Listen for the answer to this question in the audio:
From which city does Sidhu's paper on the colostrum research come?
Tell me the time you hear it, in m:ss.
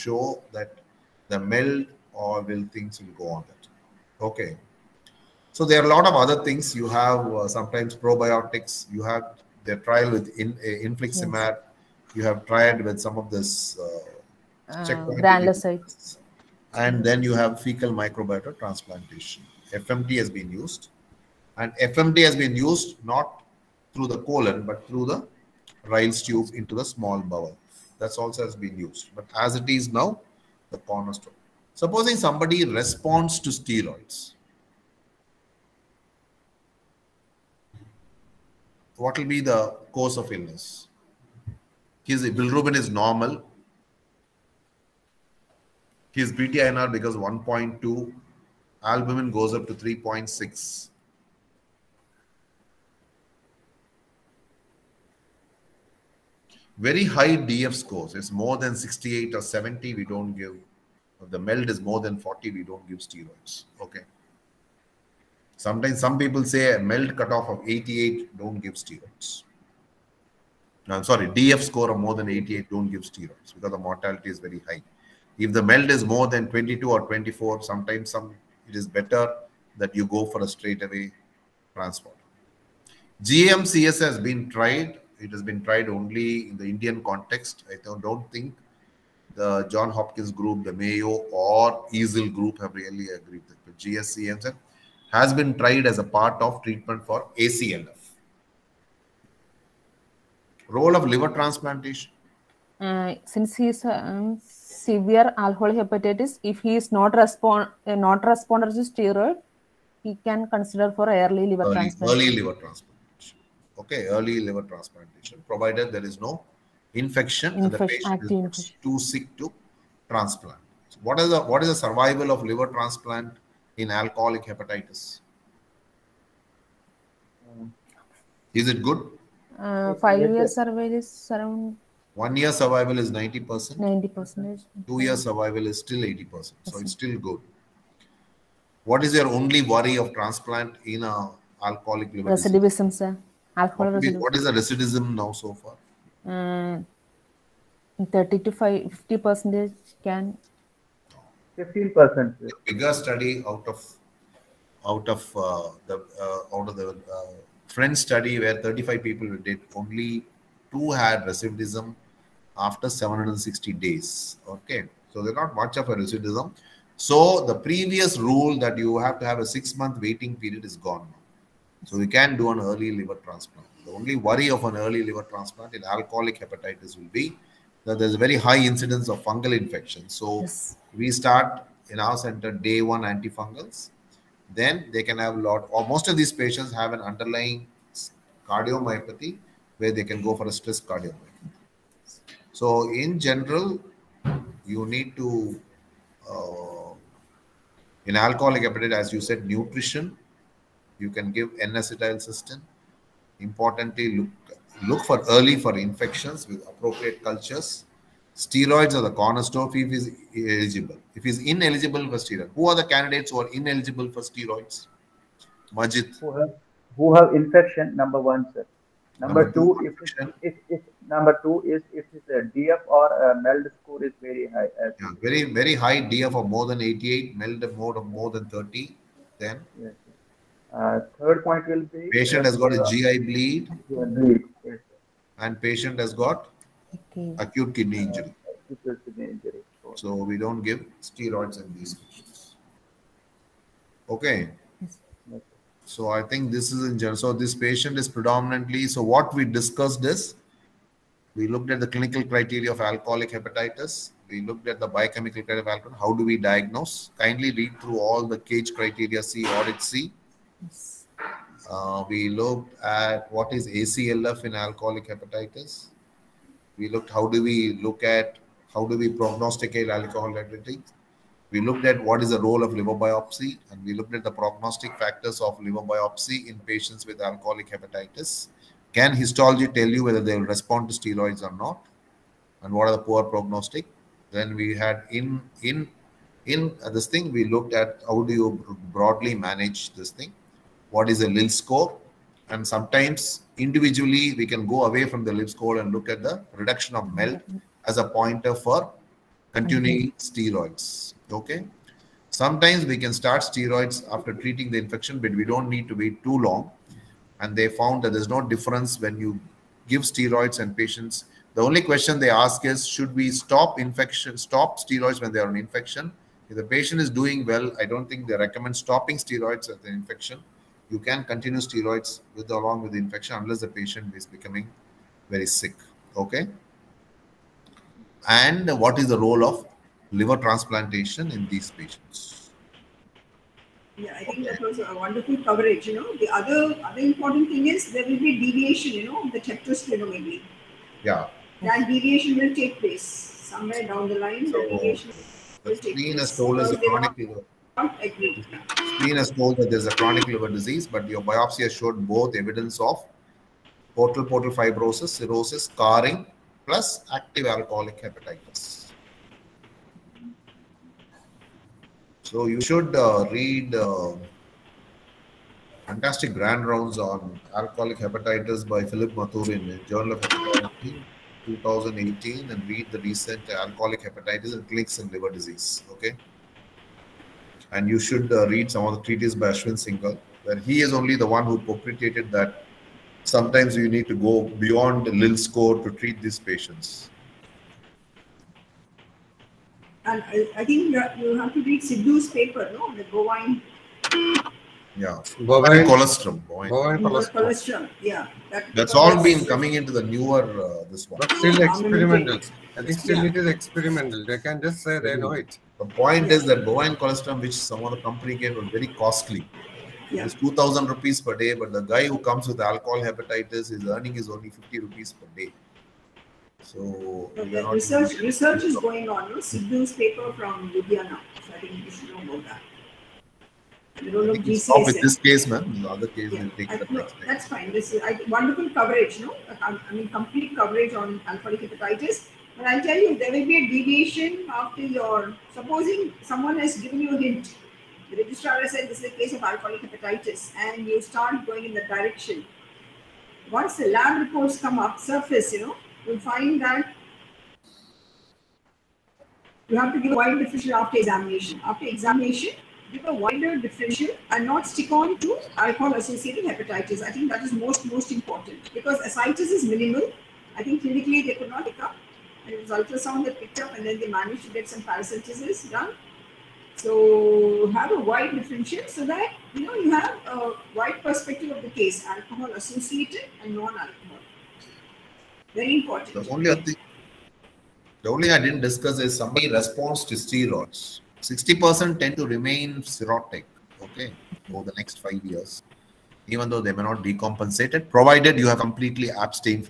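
7:00.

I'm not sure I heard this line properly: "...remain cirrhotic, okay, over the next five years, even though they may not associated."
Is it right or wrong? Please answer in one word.
wrong.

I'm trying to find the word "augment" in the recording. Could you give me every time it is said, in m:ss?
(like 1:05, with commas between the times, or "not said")
not said.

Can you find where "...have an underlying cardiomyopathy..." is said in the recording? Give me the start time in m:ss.
3:06.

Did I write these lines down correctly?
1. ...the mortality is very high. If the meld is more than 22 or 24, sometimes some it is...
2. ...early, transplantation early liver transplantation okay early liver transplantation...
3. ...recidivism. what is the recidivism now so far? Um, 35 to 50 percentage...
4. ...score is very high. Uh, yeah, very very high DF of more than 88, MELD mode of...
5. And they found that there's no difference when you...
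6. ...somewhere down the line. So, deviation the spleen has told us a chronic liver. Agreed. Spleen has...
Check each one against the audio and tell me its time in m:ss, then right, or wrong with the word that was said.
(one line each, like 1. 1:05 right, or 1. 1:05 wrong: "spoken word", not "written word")
1. 1:13 right
2. 1:51 right
3. 2:24 wrong: "30", not "35"
4. 3:43 right
5. 5:07 right
6. 5:43 right.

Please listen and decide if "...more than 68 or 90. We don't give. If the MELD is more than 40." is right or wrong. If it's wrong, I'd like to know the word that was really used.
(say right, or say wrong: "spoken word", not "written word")
wrong: "70", not "90".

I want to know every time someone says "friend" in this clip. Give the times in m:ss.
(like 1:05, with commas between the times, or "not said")
2:37.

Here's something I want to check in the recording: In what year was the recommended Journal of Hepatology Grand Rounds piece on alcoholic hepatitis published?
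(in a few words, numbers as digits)
2018.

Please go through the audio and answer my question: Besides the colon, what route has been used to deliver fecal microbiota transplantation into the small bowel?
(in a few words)
Ryle's tube.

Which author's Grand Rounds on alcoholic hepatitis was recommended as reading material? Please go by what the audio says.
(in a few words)
Philip Mathurin.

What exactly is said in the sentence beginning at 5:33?
Yeah, I think that was a wonderful coverage.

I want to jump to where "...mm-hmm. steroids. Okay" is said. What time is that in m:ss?
5:00.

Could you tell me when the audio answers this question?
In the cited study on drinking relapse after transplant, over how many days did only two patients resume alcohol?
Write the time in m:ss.
2:42.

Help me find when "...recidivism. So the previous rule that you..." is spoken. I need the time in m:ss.
2:45.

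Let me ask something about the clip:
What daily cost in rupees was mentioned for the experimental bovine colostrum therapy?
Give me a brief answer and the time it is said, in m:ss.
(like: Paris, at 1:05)
2000 rupees, at 6:50.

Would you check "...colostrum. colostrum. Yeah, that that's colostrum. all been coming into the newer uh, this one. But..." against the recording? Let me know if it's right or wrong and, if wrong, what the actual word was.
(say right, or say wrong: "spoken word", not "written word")
right.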